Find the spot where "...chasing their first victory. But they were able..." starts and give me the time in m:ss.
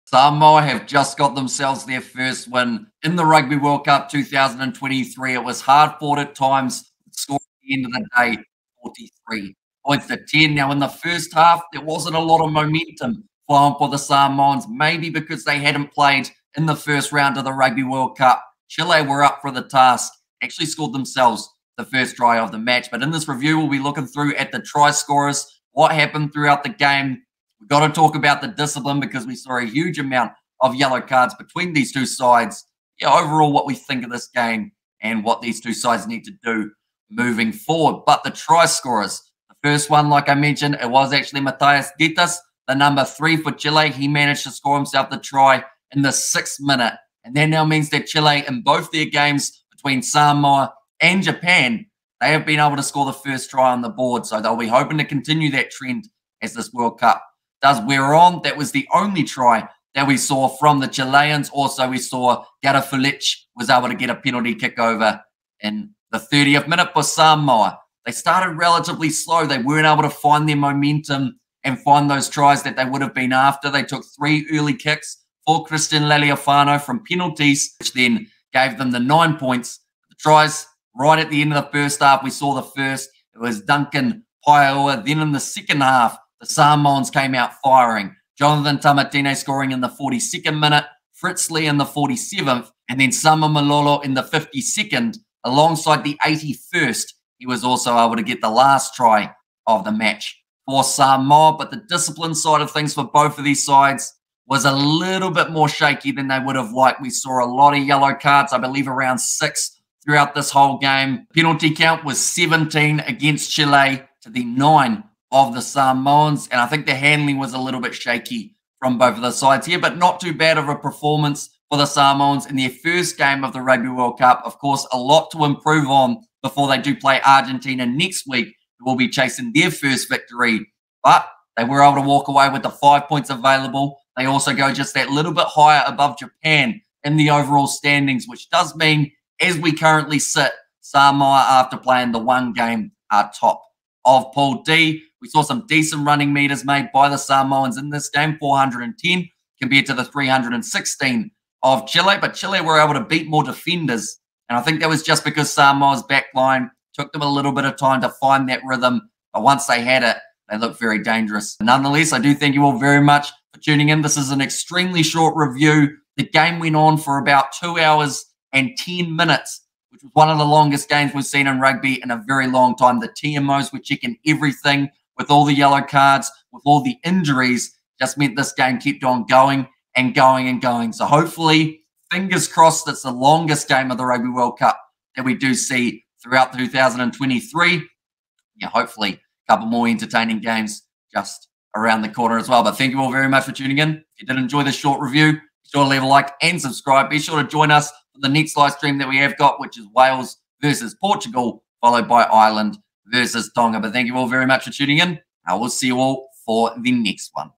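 2:09.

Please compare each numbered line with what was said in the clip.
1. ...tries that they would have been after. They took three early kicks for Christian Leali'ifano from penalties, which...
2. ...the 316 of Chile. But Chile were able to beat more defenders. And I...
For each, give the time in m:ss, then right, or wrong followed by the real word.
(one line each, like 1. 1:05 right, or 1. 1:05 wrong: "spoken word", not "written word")
1. 1:12 right
2. 2:29 right.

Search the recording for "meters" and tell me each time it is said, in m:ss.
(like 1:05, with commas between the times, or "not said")
2:26.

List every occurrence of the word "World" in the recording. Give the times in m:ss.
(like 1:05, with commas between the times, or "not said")
0:03, 0:17, 0:56, 2:03, 3:04.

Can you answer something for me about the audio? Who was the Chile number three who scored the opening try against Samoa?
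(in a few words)
Matthias Dittus.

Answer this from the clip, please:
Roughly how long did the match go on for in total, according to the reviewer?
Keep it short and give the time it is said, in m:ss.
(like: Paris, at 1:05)
2 hours and 10 minutes, at 2:47.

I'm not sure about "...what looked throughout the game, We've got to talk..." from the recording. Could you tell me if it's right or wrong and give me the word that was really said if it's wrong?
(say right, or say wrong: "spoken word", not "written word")
wrong: "happened", not "looked".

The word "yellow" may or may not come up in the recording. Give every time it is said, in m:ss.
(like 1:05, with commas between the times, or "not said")
0:30, 1:47, 2:55.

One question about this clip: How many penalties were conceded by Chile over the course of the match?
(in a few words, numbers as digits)
17.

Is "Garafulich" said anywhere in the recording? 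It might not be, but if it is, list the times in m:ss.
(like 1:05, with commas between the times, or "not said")
1:02.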